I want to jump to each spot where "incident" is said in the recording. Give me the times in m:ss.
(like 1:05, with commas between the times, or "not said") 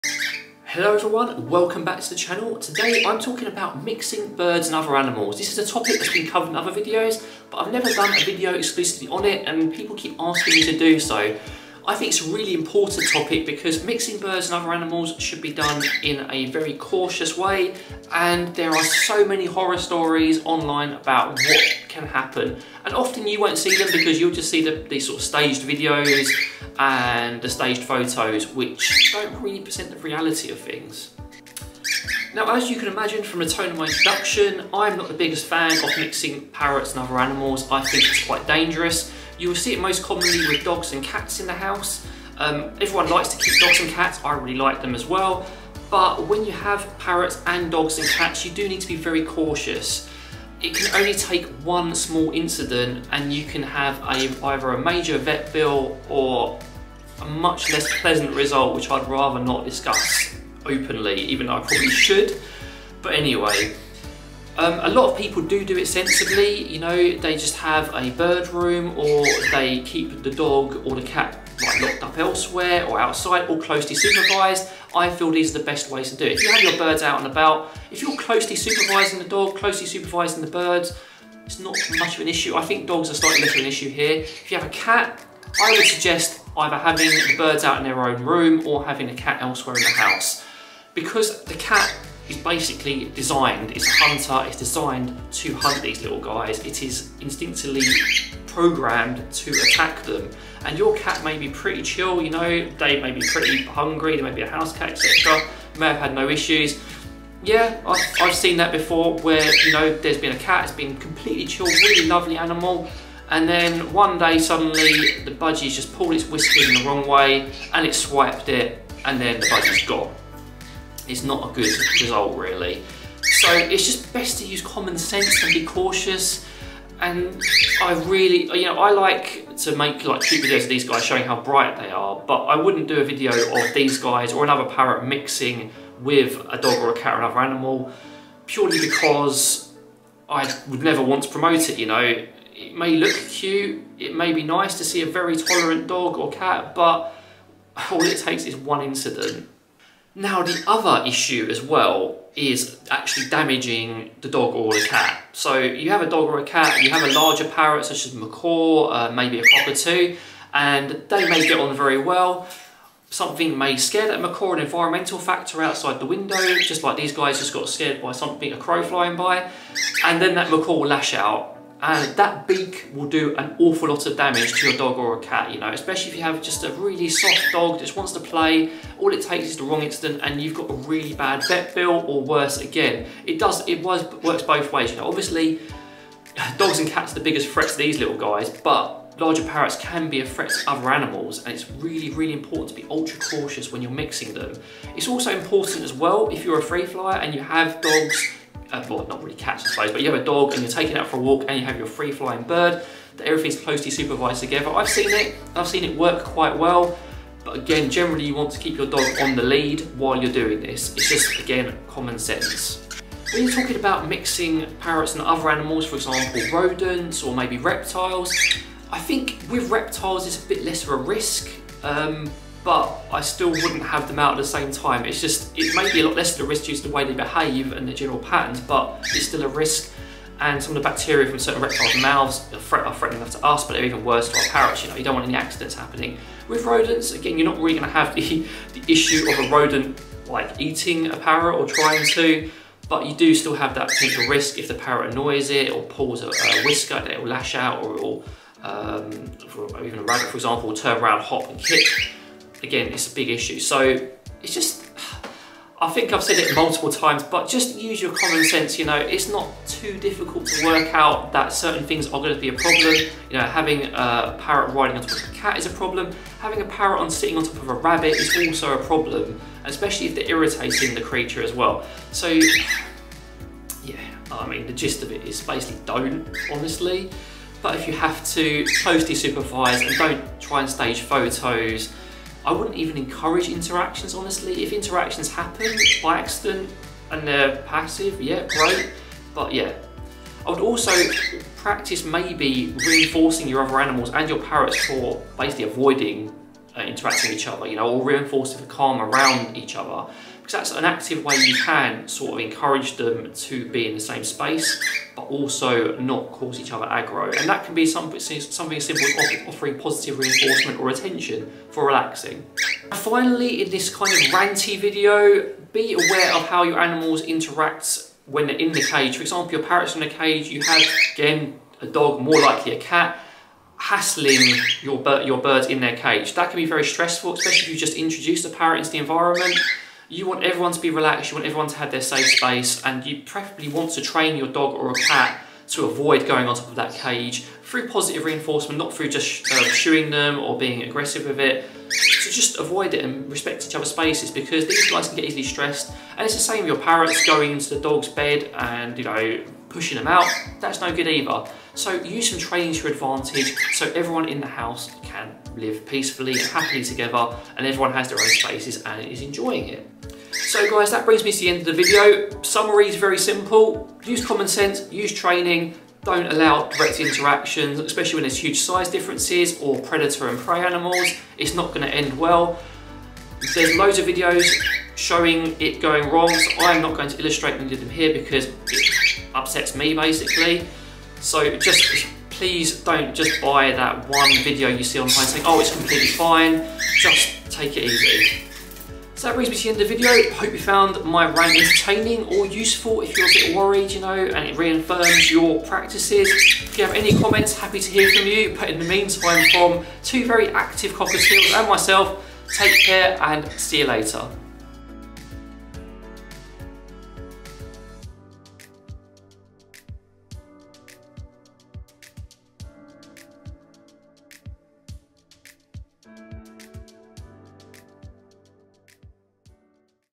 0:52, 2:28, 2:59.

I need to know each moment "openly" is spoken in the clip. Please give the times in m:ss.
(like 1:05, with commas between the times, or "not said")
1:00.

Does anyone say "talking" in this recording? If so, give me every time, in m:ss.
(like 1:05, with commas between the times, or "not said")
0:03, 3:33.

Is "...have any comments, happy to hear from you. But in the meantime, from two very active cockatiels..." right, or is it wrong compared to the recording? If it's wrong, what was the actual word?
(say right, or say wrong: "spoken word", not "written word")
right.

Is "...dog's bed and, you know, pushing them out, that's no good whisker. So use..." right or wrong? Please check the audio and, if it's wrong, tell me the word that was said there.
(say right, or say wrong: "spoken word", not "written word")
wrong: "either", not "whisker".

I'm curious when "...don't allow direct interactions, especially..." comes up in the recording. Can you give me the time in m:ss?
6:06.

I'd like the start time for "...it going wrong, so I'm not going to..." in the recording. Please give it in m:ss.
6:15.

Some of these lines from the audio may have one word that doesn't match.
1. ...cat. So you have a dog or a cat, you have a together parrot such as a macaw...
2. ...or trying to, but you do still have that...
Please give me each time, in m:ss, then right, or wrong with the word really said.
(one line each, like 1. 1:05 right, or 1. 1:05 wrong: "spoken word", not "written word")
1. 2:34 wrong: "larger", not "together"
2. 4:01 right.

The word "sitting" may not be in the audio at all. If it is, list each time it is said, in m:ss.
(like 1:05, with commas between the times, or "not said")
4:27.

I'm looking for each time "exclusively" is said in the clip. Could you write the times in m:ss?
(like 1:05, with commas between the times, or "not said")
0:08.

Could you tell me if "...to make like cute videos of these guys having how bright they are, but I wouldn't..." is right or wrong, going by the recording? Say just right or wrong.
wrong.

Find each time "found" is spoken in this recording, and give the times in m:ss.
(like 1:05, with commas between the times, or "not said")
6:30.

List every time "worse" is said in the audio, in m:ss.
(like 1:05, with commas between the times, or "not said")
3:02, 3:54.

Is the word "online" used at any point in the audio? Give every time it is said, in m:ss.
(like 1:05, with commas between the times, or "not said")
0:20, 6:24.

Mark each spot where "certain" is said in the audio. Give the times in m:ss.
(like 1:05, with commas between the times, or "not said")
3:51, 4:21.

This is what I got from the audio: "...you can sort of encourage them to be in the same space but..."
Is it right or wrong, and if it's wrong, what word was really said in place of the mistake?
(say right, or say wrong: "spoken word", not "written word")
right.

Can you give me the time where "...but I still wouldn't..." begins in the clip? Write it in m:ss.
3:42.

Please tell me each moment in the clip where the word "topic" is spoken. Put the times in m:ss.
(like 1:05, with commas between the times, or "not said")
0:05, 0:13.